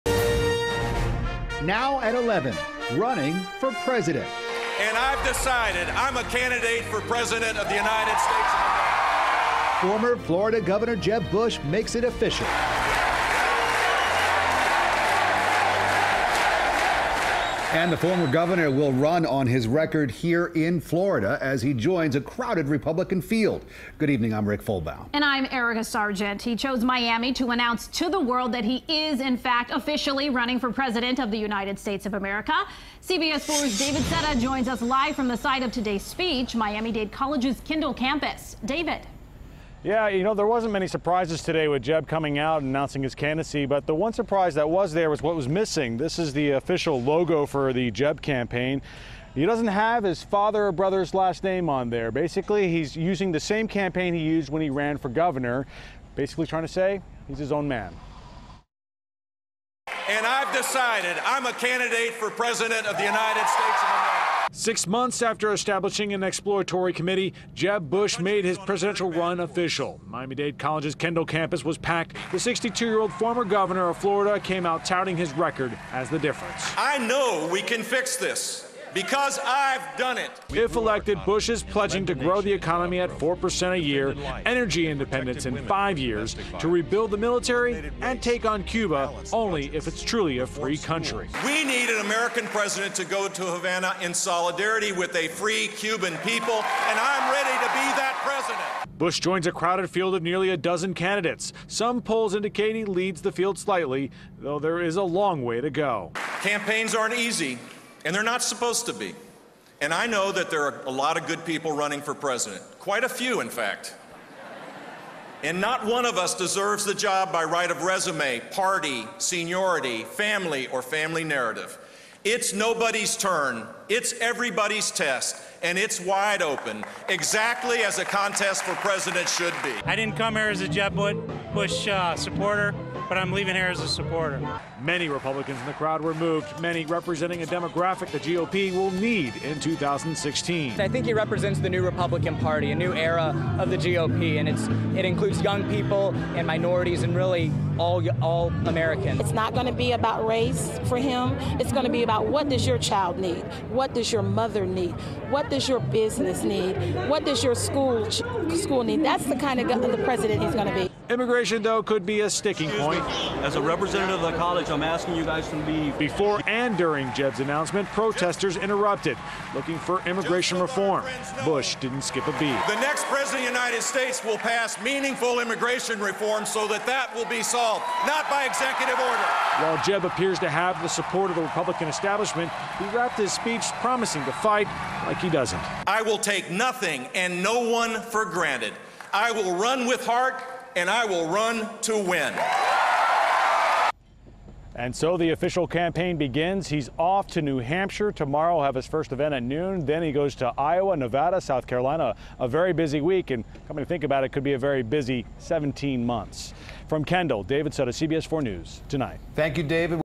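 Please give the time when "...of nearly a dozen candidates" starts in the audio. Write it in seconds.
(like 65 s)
100 s.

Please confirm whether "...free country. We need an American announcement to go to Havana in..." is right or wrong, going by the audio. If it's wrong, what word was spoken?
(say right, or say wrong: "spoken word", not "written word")
wrong: "president", not "announcement".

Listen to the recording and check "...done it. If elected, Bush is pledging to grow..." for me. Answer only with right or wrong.
right.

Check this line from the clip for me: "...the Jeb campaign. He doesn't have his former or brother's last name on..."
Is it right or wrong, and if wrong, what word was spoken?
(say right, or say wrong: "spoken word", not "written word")
wrong: "father", not "former".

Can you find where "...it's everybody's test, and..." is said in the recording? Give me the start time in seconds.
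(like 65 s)
123 s.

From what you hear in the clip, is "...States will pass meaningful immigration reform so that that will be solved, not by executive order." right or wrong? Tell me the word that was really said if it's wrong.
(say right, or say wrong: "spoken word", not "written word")
right.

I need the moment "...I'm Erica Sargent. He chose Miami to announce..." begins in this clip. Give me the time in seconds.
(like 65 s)
25 s.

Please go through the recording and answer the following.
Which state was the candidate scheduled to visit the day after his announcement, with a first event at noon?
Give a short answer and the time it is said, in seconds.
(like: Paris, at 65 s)
New Hampshire, at 197 s.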